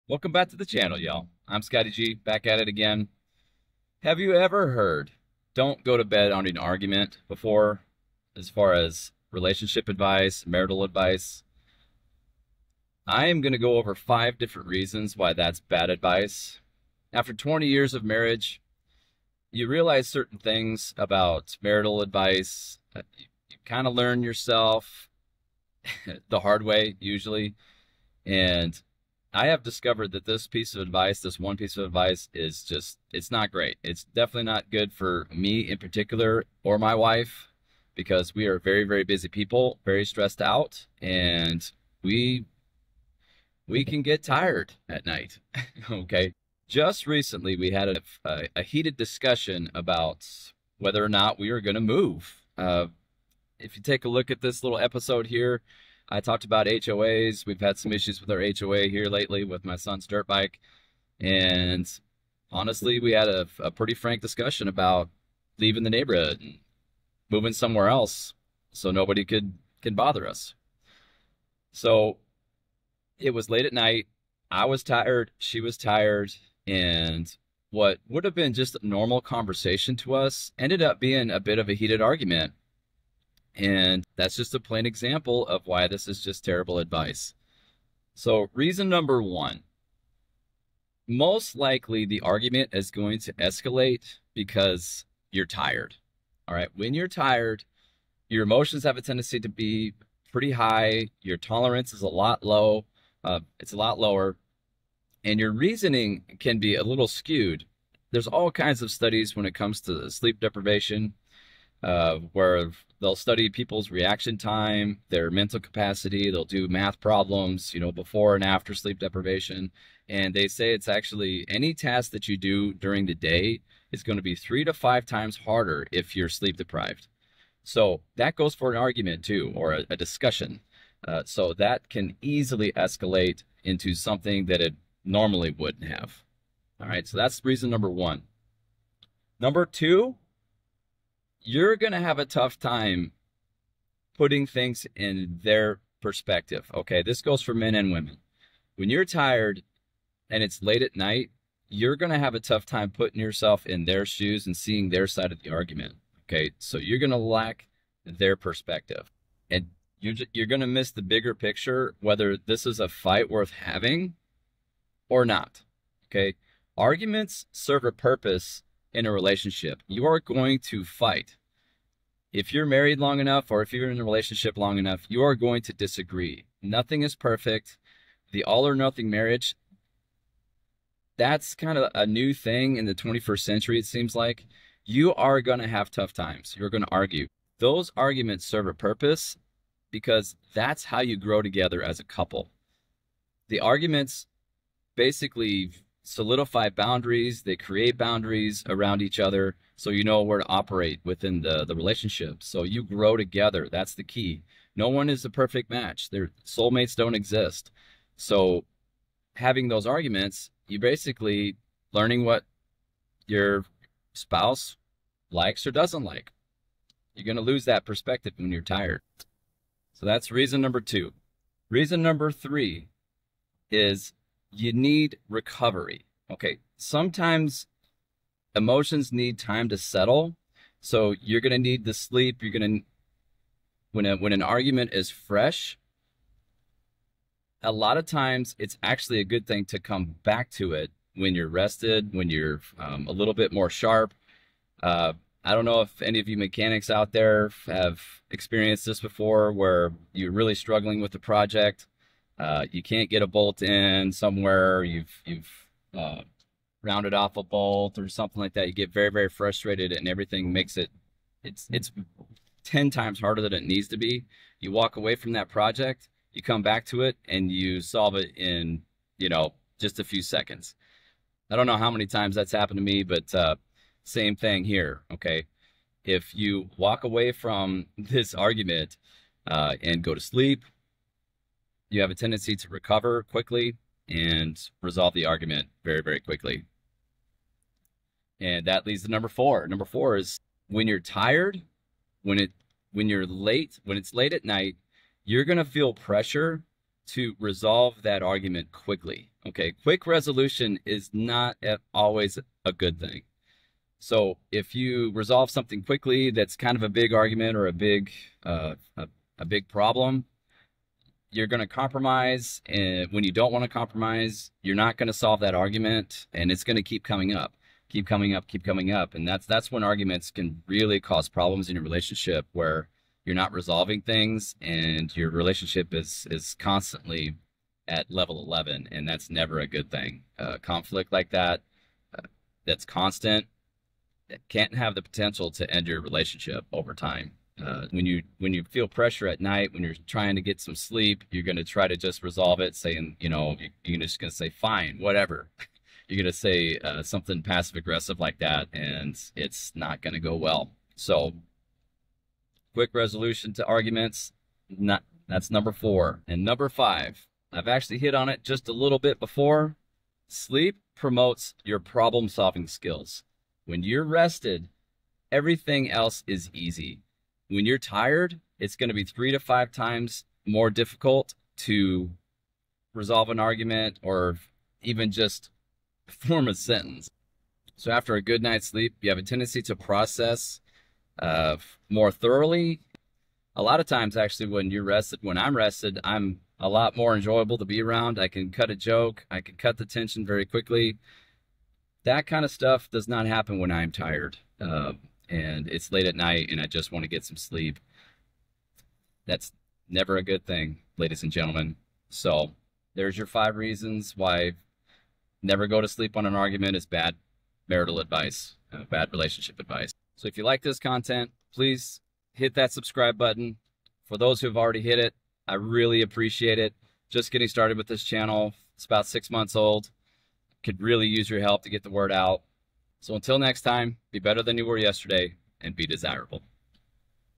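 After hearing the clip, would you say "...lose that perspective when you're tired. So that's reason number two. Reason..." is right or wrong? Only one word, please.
right.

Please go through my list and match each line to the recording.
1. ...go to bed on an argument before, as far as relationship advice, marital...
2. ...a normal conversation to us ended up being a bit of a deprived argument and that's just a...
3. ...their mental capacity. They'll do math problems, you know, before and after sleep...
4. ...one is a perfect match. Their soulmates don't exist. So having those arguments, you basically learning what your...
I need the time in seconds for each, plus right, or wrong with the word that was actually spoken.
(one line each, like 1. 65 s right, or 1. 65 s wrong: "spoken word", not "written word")
1. 5 s right
2. 78 s wrong: "heated", not "deprived"
3. 115 s right
4. 204 s right.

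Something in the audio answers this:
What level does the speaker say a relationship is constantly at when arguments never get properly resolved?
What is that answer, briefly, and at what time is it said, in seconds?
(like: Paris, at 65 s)
11, at 328 s.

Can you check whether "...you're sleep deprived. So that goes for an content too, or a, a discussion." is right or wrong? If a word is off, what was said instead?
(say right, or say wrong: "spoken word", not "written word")
wrong: "argument", not "content".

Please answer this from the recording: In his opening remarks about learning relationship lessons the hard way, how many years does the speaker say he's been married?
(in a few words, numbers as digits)
20.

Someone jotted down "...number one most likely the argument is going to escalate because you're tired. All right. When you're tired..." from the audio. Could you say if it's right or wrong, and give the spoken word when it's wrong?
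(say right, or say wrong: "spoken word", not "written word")
right.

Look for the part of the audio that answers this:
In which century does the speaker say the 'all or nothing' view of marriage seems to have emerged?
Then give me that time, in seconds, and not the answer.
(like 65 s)
182 s.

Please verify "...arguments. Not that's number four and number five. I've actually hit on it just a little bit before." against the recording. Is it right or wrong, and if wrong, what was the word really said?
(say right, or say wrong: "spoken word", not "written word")
right.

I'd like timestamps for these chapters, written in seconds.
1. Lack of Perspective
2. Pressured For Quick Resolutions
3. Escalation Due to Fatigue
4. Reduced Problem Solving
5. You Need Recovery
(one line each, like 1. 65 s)
1. 140 s
2. 290 s
3. 90 s
4. 360 s
5. 224 s.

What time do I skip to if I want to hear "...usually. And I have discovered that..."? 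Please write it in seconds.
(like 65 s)
26 s.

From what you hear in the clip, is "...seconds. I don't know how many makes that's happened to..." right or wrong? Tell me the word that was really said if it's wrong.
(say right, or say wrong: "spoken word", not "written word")
wrong: "times", not "makes".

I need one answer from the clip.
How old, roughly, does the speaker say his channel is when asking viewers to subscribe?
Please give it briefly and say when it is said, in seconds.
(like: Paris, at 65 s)
About 6 months, at 418 s.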